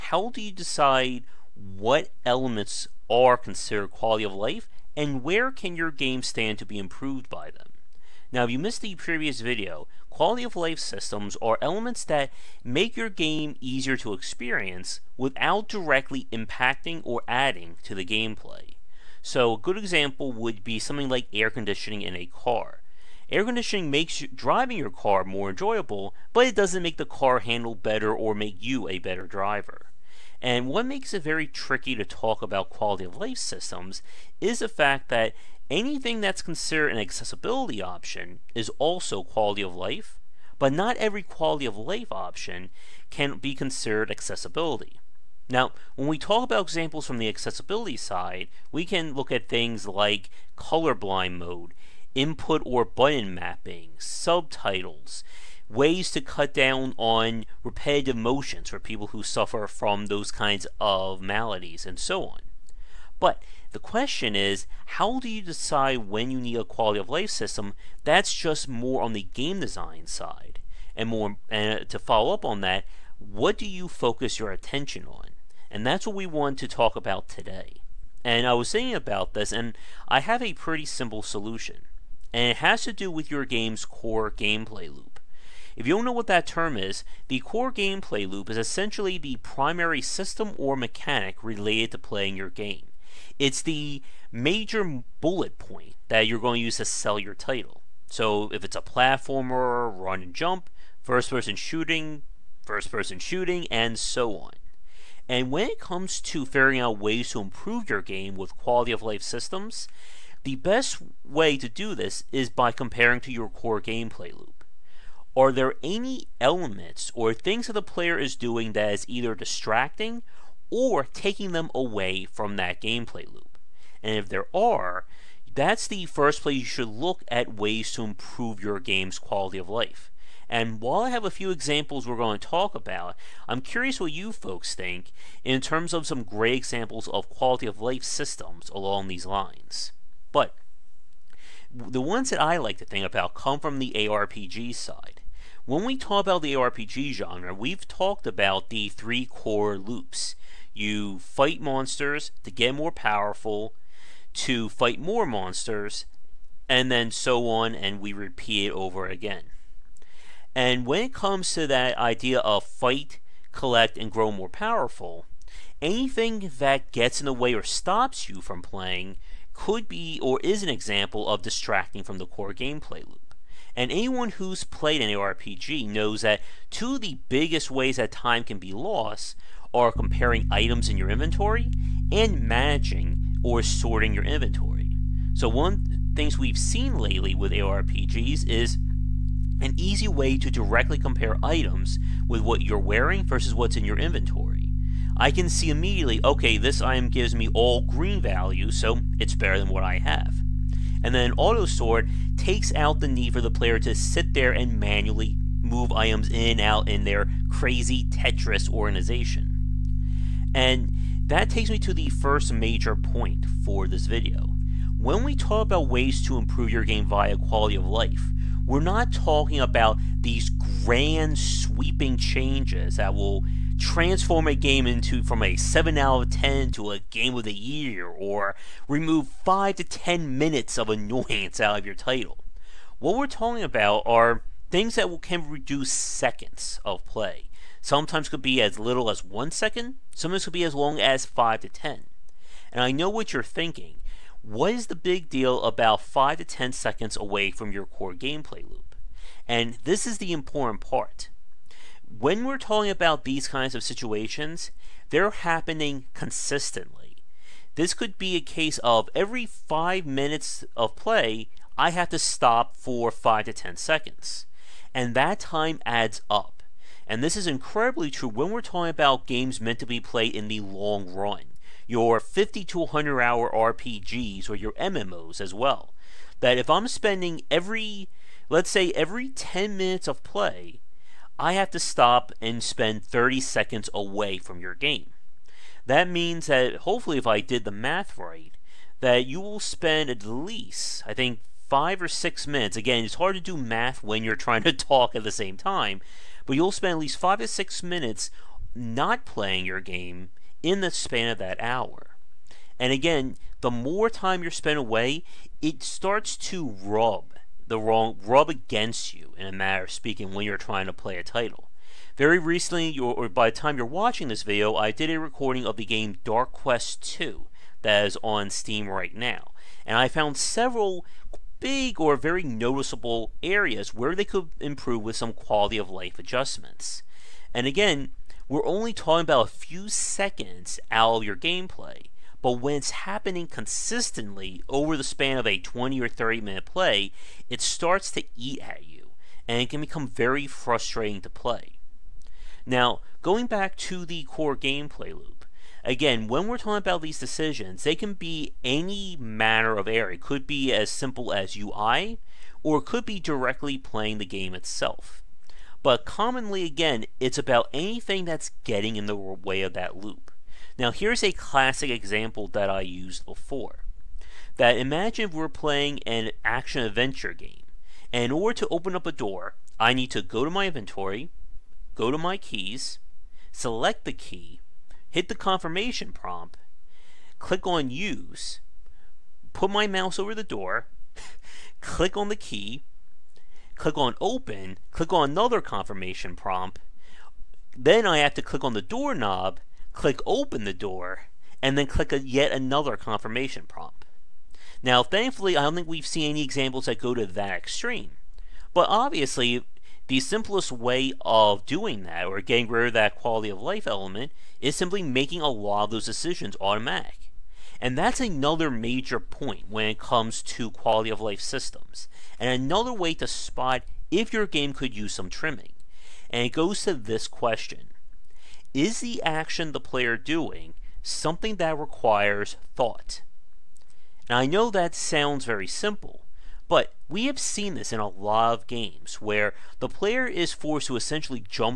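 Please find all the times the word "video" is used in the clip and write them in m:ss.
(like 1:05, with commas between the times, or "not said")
0:09, 3:34, 5:14.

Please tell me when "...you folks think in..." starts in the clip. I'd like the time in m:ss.
2:14.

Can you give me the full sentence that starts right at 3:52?
What we're talking about are things that can reduce seconds of play.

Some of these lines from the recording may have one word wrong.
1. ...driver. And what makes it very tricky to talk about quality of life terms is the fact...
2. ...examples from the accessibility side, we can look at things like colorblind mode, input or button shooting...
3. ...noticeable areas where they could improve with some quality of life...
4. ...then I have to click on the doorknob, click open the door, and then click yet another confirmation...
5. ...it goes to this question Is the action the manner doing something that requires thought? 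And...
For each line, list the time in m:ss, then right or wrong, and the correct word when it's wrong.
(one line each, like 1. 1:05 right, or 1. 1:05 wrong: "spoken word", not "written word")
1. 0:29 wrong: "systems", not "terms"
2. 0:46 wrong: "mapping", not "shooting"
3. 5:22 right
4. 6:27 right
5. 6:56 wrong: "player", not "manner".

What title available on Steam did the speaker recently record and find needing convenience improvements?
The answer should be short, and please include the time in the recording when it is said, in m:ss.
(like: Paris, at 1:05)
Dark Quest 2, at 5:16.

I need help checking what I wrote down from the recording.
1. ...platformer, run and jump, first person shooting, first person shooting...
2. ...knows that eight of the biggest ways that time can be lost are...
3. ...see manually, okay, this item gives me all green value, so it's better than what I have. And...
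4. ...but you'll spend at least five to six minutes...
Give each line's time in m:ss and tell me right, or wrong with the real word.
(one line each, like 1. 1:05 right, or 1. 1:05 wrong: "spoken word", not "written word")
1. 1:38 right
2. 2:55 wrong: "two", not "eight"
3. 3:15 wrong: "immediately", not "manually"
4. 4:56 right.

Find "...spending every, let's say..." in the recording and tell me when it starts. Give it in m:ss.
4:36.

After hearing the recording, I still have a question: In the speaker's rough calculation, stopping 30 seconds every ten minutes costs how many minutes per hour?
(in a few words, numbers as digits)
5 or 6 minutes.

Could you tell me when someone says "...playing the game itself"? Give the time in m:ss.
5:53.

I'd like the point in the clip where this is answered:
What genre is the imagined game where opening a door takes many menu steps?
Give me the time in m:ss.
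6:06.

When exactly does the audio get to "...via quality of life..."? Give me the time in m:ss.
3:37.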